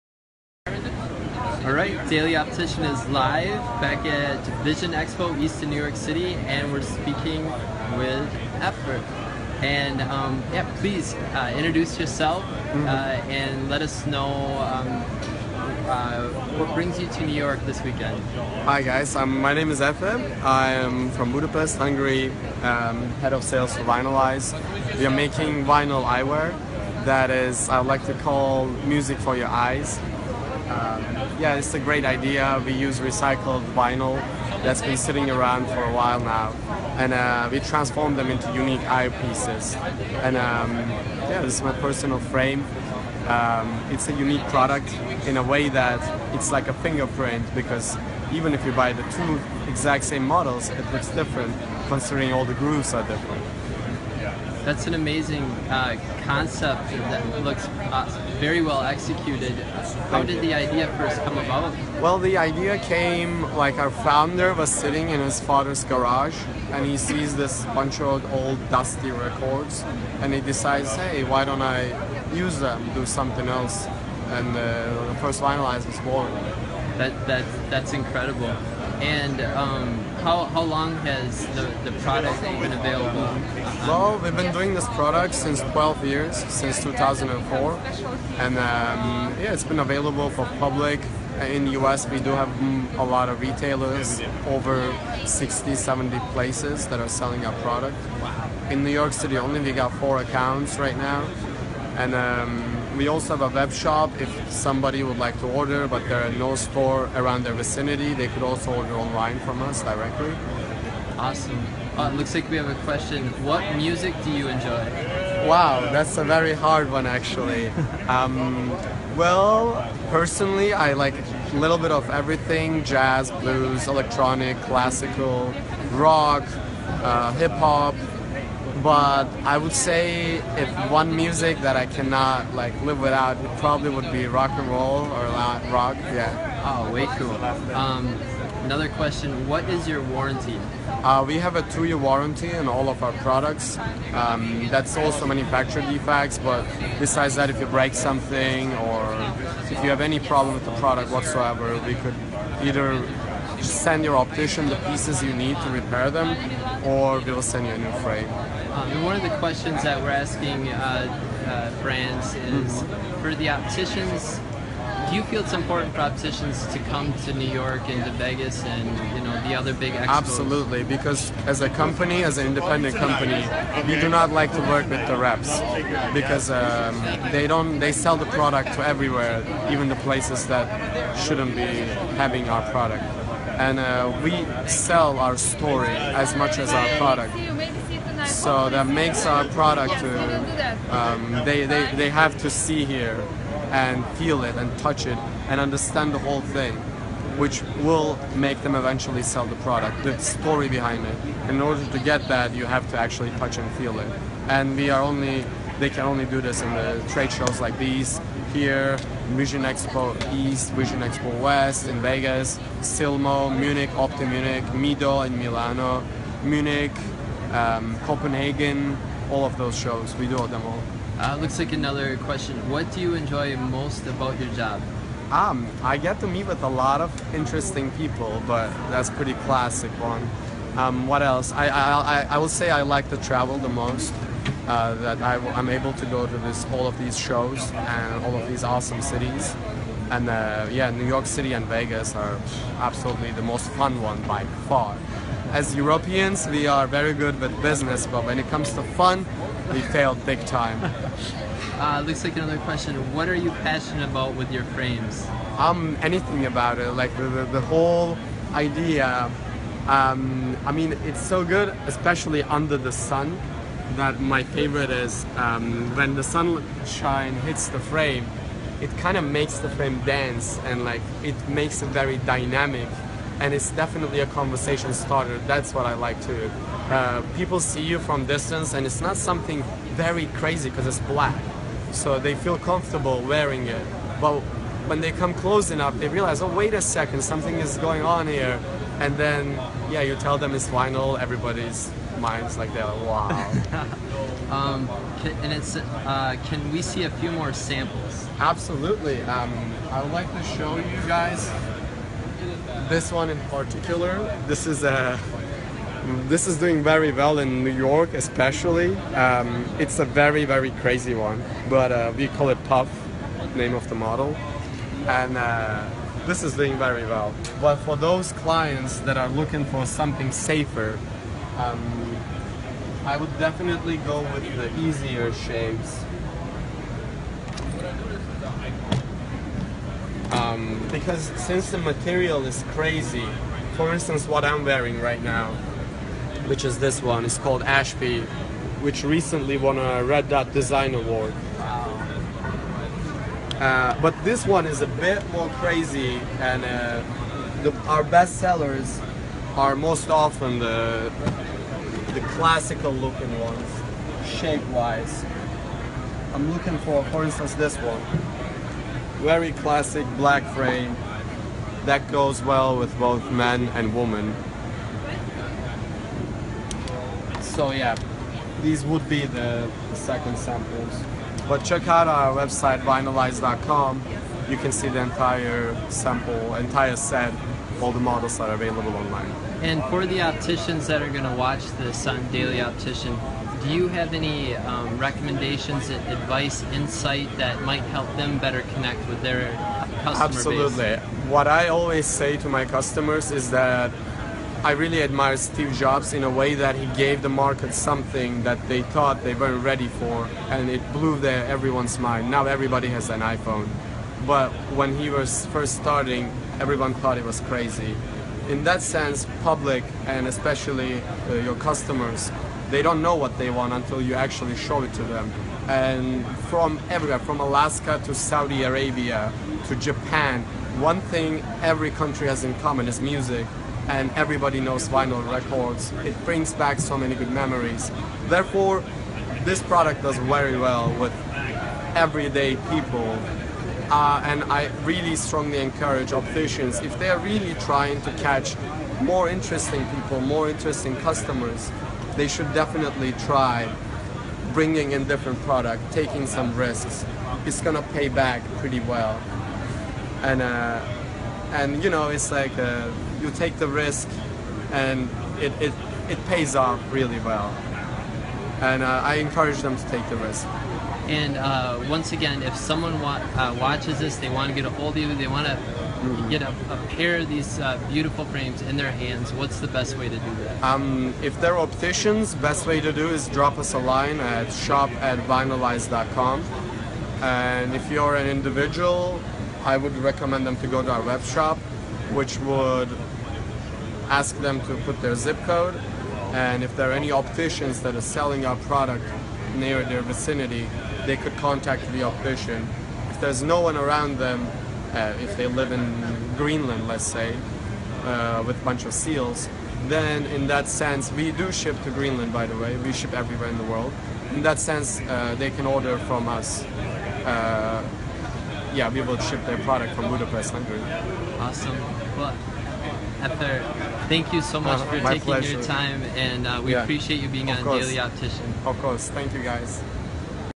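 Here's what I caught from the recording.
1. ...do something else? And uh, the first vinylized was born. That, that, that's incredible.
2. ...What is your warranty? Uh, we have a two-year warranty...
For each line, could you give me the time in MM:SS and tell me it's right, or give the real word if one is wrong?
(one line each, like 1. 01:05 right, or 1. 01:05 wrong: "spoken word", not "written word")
1. 01:12 right
2. 02:19 right.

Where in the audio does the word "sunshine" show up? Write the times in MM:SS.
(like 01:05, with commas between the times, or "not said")
04:26.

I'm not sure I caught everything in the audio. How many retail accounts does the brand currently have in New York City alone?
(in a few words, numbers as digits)
4.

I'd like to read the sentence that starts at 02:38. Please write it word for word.
Um, and one of the questions that we're asking uh, uh, brands is mm-hmm.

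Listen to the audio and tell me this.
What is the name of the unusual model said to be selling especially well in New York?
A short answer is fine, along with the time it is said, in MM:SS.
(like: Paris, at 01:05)
Puff, at 05:12.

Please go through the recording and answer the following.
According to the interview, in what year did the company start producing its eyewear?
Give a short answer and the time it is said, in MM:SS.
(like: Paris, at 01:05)
2004, at 01:26.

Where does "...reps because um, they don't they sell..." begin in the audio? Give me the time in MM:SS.
02:55.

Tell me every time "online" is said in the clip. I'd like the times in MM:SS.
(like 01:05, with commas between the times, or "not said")
01:48, 06:18.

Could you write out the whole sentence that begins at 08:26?
Uh, yeah, we will ship their product from Budapest, Hungary.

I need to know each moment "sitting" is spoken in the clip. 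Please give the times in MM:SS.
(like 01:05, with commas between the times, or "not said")
00:34, 01:04.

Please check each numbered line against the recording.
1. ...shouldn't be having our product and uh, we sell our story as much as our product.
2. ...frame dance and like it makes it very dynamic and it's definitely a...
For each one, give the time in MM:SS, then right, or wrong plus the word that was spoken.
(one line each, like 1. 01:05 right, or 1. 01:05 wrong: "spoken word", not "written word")
1. 03:01 right
2. 04:29 right.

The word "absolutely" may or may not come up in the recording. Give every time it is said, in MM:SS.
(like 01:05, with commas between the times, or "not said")
02:50, 04:02, 04:58, 06:30.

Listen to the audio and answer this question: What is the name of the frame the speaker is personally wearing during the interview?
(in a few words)
Ashby.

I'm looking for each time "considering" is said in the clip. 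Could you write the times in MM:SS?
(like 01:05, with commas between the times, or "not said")
00:51.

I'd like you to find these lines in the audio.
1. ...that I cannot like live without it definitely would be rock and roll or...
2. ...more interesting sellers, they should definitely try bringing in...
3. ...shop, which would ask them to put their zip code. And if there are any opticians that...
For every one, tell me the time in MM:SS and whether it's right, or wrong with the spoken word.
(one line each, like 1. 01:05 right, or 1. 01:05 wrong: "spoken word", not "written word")
1. 02:11 wrong: "probably", not "definitely"
2. 07:20 wrong: "customers", not "sellers"
3. 08:01 right.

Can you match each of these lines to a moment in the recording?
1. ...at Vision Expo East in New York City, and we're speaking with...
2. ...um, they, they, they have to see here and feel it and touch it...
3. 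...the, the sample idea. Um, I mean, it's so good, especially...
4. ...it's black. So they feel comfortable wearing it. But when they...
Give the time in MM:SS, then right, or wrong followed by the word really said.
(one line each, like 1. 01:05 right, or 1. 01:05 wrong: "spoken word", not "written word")
1. 00:04 right
2. 03:10 right
3. 04:17 wrong: "whole", not "sample"
4. 04:40 right.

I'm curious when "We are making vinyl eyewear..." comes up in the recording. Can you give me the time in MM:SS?
00:24.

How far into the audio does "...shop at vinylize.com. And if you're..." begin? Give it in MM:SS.
07:54.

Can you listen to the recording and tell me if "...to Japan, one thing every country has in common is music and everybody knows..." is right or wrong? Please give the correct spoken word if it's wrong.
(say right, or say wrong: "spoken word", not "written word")
right.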